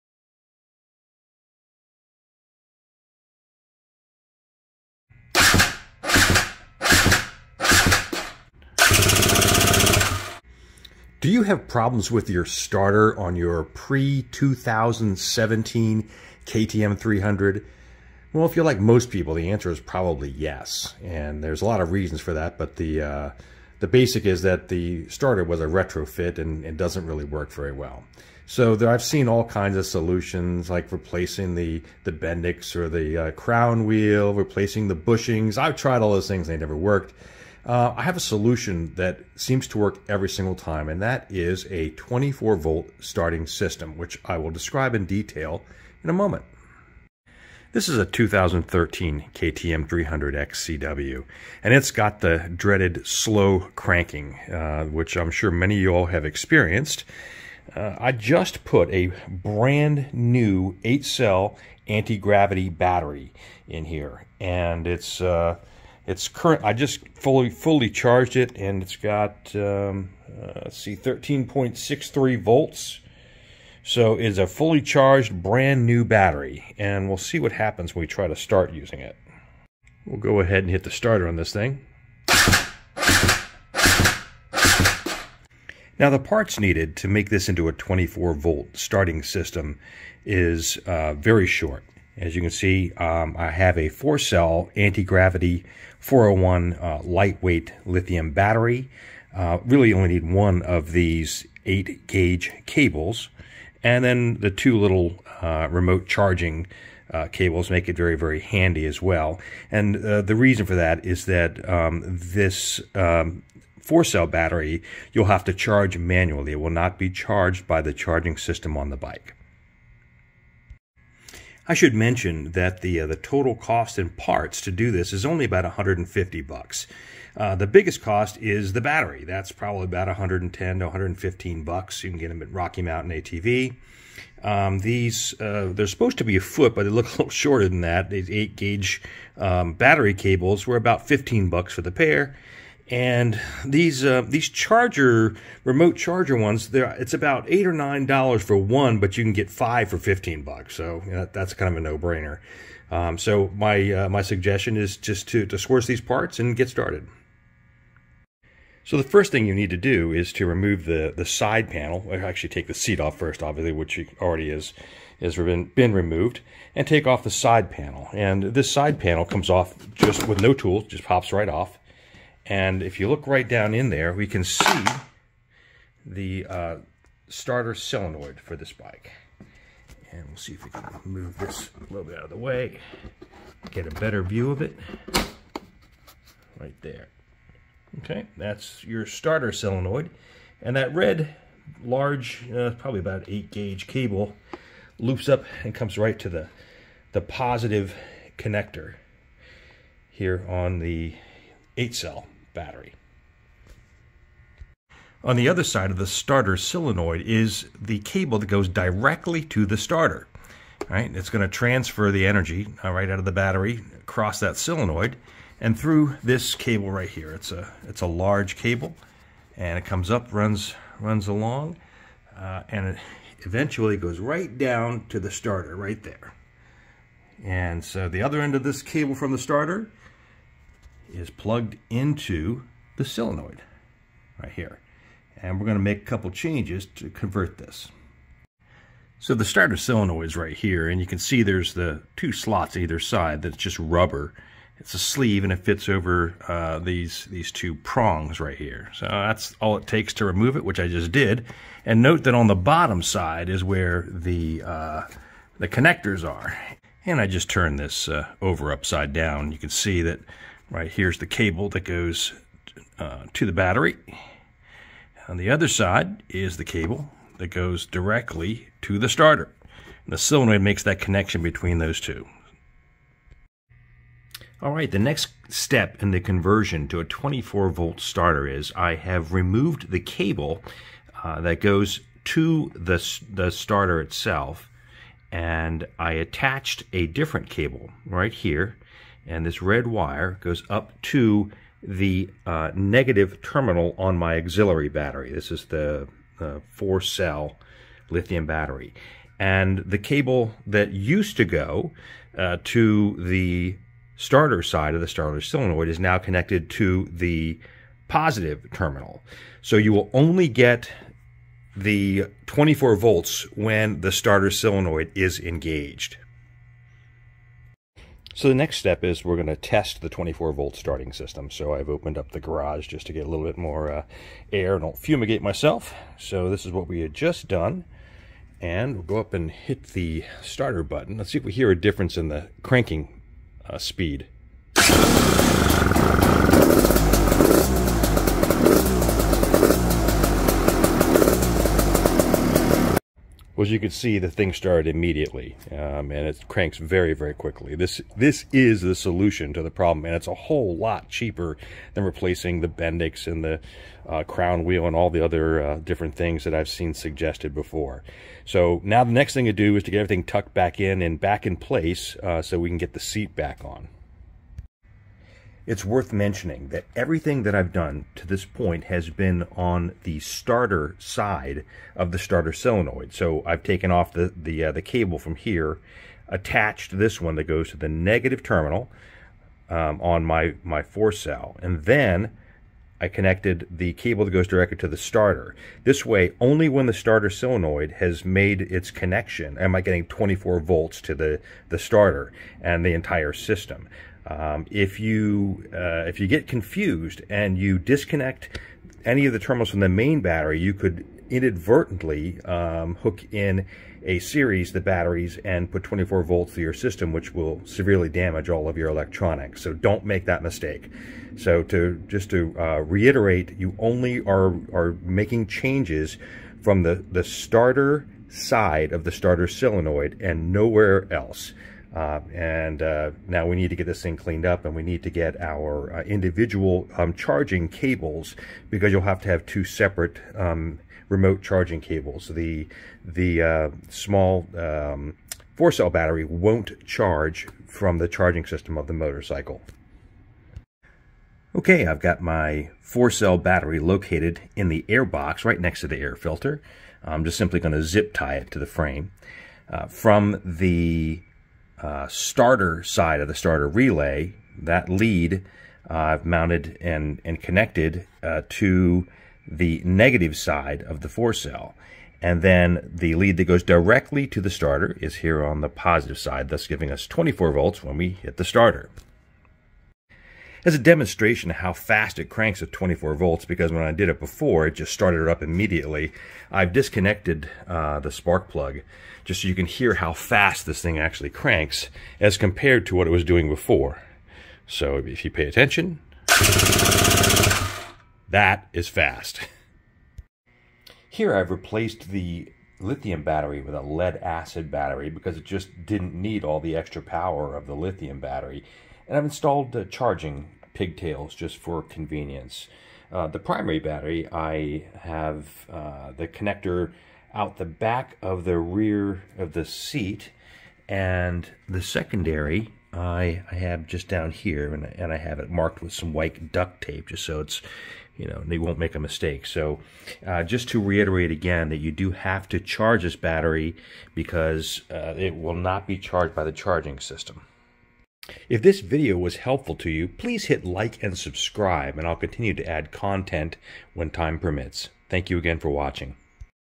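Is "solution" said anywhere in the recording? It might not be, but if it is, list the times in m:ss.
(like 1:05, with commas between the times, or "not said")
0:29, 0:38, 5:48.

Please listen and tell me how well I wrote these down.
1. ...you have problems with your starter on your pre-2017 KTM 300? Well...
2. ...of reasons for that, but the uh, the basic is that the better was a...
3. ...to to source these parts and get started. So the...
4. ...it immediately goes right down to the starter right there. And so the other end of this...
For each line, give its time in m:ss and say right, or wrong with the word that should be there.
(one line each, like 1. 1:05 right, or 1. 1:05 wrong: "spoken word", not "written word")
1. 0:11 right
2. 0:21 wrong: "starter", not "better"
3. 2:35 right
4. 3:42 wrong: "eventually", not "immediately".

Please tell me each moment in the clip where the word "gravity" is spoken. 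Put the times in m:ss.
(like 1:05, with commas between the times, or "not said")
1:01, 1:34.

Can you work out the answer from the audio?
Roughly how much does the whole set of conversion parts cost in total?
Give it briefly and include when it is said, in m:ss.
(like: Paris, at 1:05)
$150, at 2:05.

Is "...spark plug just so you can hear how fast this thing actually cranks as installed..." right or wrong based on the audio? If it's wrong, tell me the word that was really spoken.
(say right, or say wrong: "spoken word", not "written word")
wrong: "compared", not "installed".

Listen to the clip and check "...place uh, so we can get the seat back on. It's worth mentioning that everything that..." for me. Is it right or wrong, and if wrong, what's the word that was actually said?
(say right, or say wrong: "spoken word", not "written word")
right.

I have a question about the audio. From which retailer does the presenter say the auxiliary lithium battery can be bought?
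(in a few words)
Rocky Mountain ATV.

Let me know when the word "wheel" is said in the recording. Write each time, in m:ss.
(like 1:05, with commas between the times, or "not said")
0:33, 5:54.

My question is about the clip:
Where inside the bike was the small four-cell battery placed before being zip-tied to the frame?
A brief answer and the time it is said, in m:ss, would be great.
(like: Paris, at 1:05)
the air box, at 7:24.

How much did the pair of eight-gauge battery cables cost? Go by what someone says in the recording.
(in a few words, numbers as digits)
$15.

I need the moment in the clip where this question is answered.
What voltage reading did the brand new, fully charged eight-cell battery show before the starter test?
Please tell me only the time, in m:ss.
1:10.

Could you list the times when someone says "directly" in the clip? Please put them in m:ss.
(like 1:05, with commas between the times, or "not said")
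3:28, 4:27, 6:24, 7:43.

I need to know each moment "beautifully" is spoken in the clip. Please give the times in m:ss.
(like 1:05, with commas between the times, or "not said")
not said.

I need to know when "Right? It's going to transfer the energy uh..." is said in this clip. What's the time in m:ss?
3:30.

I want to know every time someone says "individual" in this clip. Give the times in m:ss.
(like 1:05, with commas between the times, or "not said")
7:06.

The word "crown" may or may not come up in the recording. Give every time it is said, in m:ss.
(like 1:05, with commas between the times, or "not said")
0:33, 5:54.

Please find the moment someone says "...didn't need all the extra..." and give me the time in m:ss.
8:15.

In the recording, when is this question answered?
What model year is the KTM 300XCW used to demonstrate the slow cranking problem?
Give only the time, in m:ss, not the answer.
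0:48.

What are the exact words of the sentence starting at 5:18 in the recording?
So the next step is we're going to test the 24 volt starting system.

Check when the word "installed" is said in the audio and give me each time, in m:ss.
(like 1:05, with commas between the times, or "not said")
8:19.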